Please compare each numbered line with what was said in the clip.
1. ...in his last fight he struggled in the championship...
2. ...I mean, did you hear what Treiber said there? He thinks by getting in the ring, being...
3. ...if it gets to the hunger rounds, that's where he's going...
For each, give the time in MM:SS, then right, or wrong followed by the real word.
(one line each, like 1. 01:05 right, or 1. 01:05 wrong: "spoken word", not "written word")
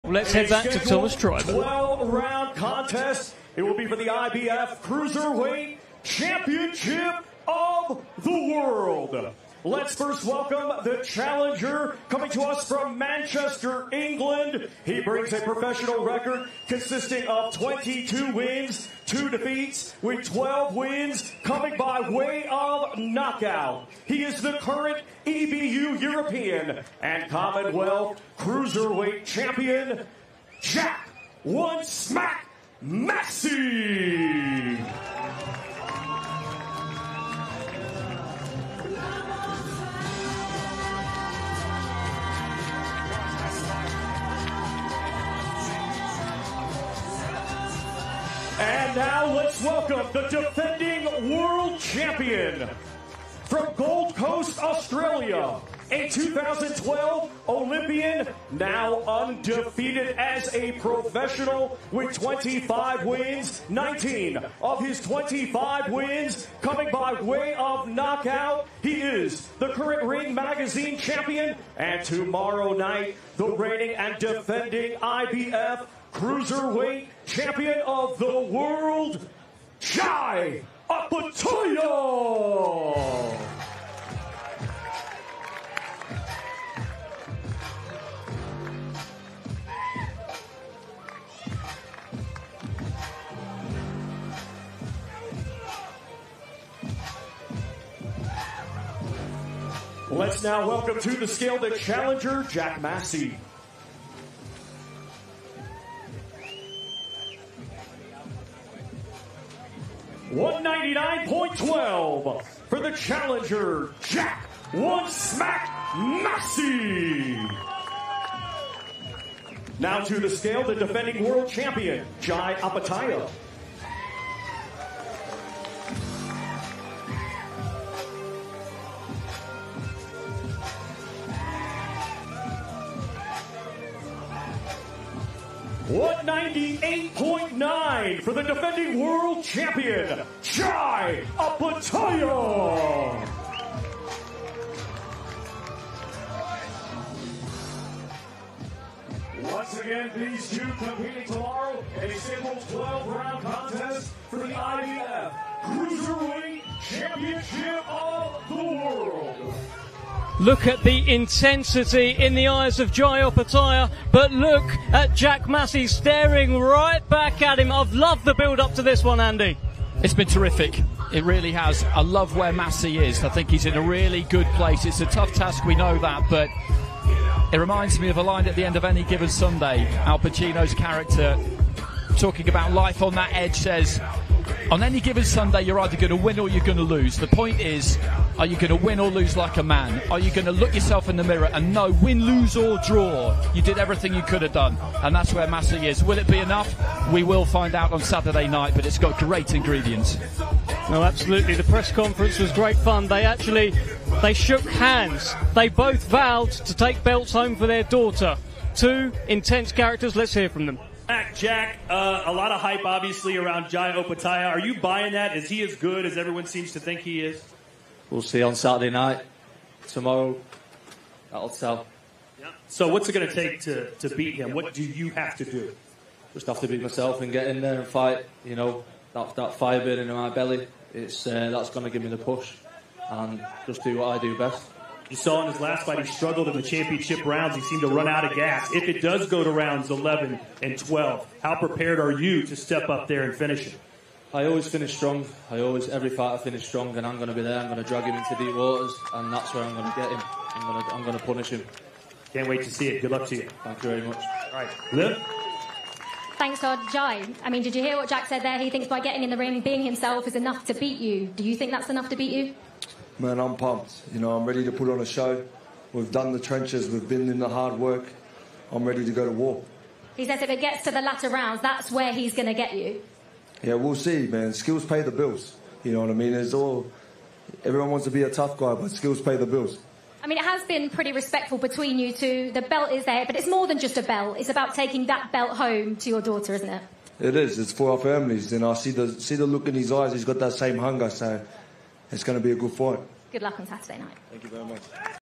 1. 03:55 right
2. 04:17 wrong: "Jack", not "Treiber"
3. 04:30 wrong: "latter", not "hunger".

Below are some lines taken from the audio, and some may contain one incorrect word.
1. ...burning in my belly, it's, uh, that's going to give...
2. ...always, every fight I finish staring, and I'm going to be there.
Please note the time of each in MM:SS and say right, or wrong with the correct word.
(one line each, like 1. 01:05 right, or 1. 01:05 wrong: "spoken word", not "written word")
1. 03:49 right
2. 04:05 wrong: "strong", not "staring".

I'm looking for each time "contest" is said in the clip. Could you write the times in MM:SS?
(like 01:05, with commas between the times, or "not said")
00:02, 02:33.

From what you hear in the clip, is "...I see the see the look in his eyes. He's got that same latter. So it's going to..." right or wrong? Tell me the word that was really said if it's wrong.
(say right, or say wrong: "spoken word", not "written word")
wrong: "hunger", not "latter".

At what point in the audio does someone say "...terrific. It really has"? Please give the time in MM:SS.
02:50.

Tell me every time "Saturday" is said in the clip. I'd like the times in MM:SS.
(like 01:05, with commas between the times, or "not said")
03:17, 03:38, 04:53.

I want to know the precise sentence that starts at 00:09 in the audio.
Let's first welcome the challenger coming to us from Manchester, England.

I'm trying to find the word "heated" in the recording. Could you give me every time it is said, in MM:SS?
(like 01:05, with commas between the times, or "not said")
not said.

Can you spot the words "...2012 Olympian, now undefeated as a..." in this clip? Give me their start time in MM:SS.
00:56.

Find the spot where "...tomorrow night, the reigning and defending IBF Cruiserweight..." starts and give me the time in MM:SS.
01:12.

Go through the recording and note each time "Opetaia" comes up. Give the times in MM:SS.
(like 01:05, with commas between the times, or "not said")
01:20, 02:02, 02:21, 02:43, 03:33.